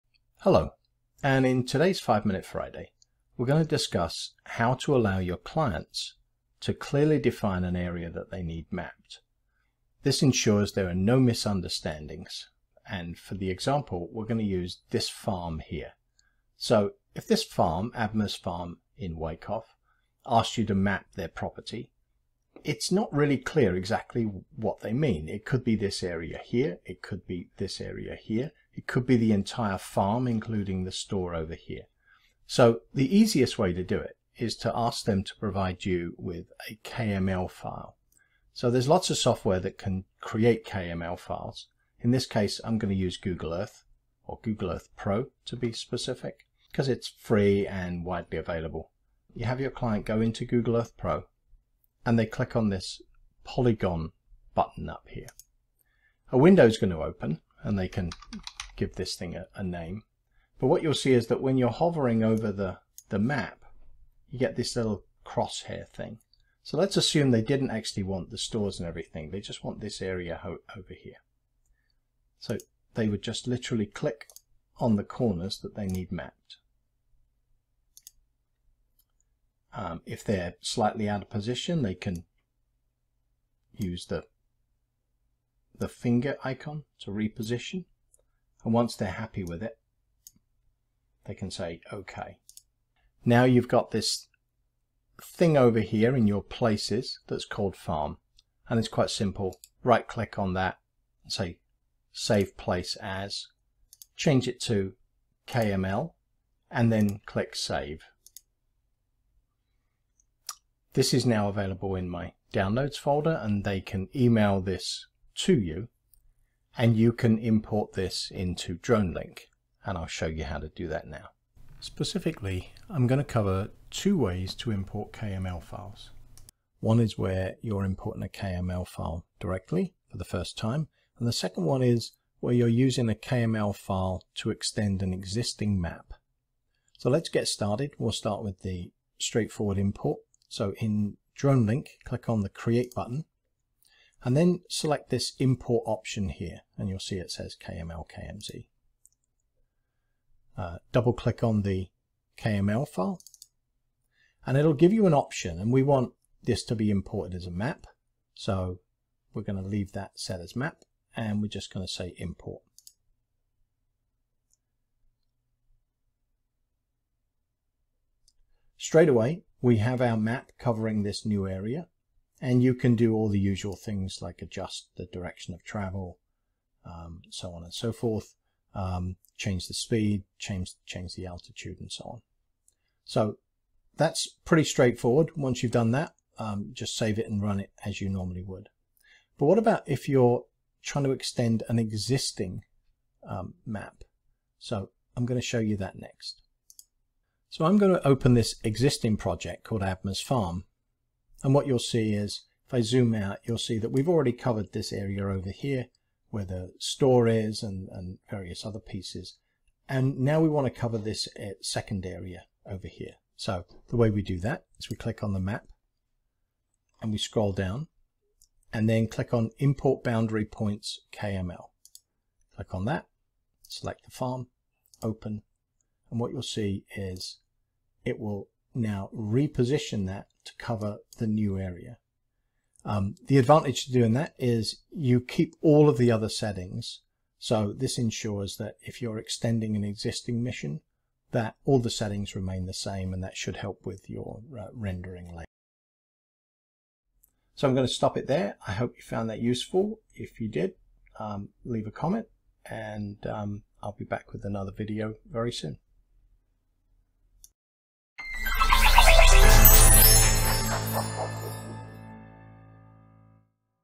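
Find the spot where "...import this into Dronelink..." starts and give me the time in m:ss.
1:57.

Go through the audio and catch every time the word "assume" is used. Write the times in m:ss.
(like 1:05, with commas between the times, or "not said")
1:06.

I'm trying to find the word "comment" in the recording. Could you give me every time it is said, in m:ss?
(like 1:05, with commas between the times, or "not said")
4:11.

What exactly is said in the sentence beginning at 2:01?
Specifically, I'm going to cover two ways to import KML files.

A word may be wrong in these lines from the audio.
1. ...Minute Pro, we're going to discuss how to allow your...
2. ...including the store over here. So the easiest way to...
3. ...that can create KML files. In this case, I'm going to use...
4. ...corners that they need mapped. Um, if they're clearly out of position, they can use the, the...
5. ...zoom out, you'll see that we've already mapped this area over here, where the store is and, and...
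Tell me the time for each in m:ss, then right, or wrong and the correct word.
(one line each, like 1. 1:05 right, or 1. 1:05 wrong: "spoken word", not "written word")
1. 0:02 wrong: "Friday", not "Pro"
2. 0:30 right
3. 0:39 right
4. 1:15 wrong: "slightly", not "clearly"
5. 3:22 wrong: "covered", not "mapped".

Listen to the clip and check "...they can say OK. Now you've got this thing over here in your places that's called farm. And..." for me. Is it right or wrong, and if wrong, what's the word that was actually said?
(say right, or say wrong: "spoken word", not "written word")
right.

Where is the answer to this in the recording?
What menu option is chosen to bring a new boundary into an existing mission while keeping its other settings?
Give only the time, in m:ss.
3:39.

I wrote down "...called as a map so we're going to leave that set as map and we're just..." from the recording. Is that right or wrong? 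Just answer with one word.
wrong.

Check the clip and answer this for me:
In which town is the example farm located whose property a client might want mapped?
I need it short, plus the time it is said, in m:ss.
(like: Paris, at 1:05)
Wyckoff, at 0:19.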